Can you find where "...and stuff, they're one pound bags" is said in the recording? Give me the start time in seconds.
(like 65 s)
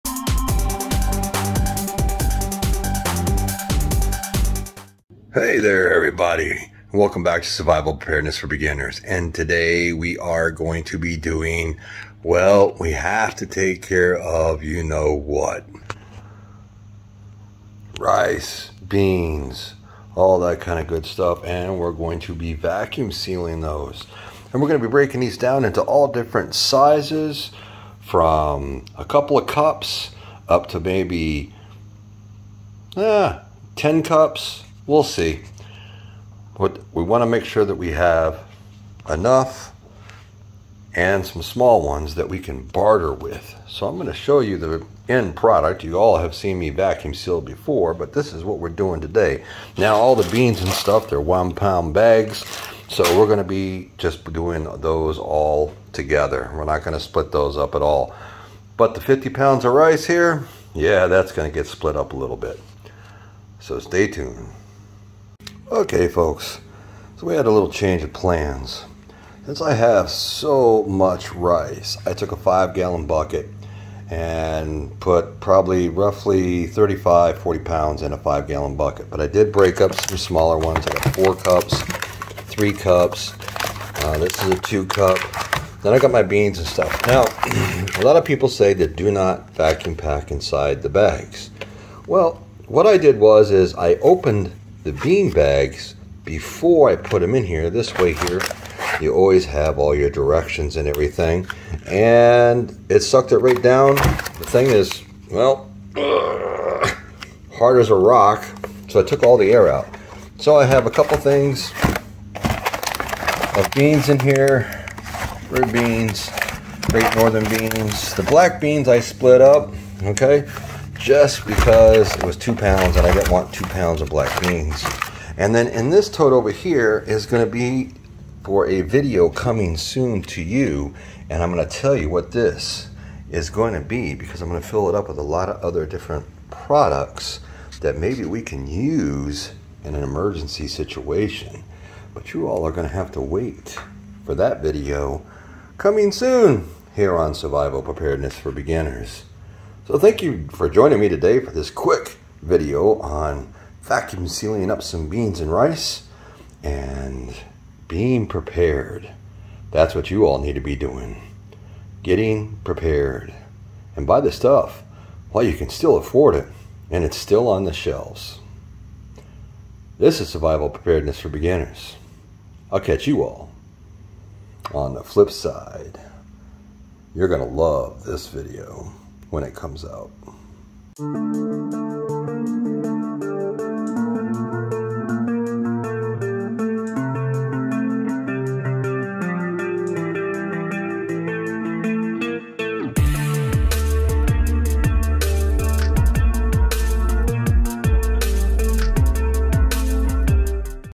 50 s.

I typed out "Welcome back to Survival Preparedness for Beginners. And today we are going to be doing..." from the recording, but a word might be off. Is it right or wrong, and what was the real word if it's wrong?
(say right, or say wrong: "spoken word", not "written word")
right.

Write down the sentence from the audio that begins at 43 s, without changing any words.
So I'm going to show you the end product.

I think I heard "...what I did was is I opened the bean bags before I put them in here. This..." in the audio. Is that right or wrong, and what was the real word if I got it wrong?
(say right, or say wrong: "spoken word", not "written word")
right.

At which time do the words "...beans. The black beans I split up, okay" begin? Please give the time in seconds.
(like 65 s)
117 s.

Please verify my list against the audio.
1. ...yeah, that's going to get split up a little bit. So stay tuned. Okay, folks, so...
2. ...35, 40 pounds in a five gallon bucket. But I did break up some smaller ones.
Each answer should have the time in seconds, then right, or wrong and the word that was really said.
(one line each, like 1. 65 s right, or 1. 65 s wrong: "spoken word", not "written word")
1. 60 s right
2. 76 s right.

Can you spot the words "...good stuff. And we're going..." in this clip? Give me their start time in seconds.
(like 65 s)
20 s.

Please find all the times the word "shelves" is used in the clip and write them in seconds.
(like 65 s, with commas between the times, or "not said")
167 s.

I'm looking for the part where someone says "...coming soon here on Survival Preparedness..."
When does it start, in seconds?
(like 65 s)
145 s.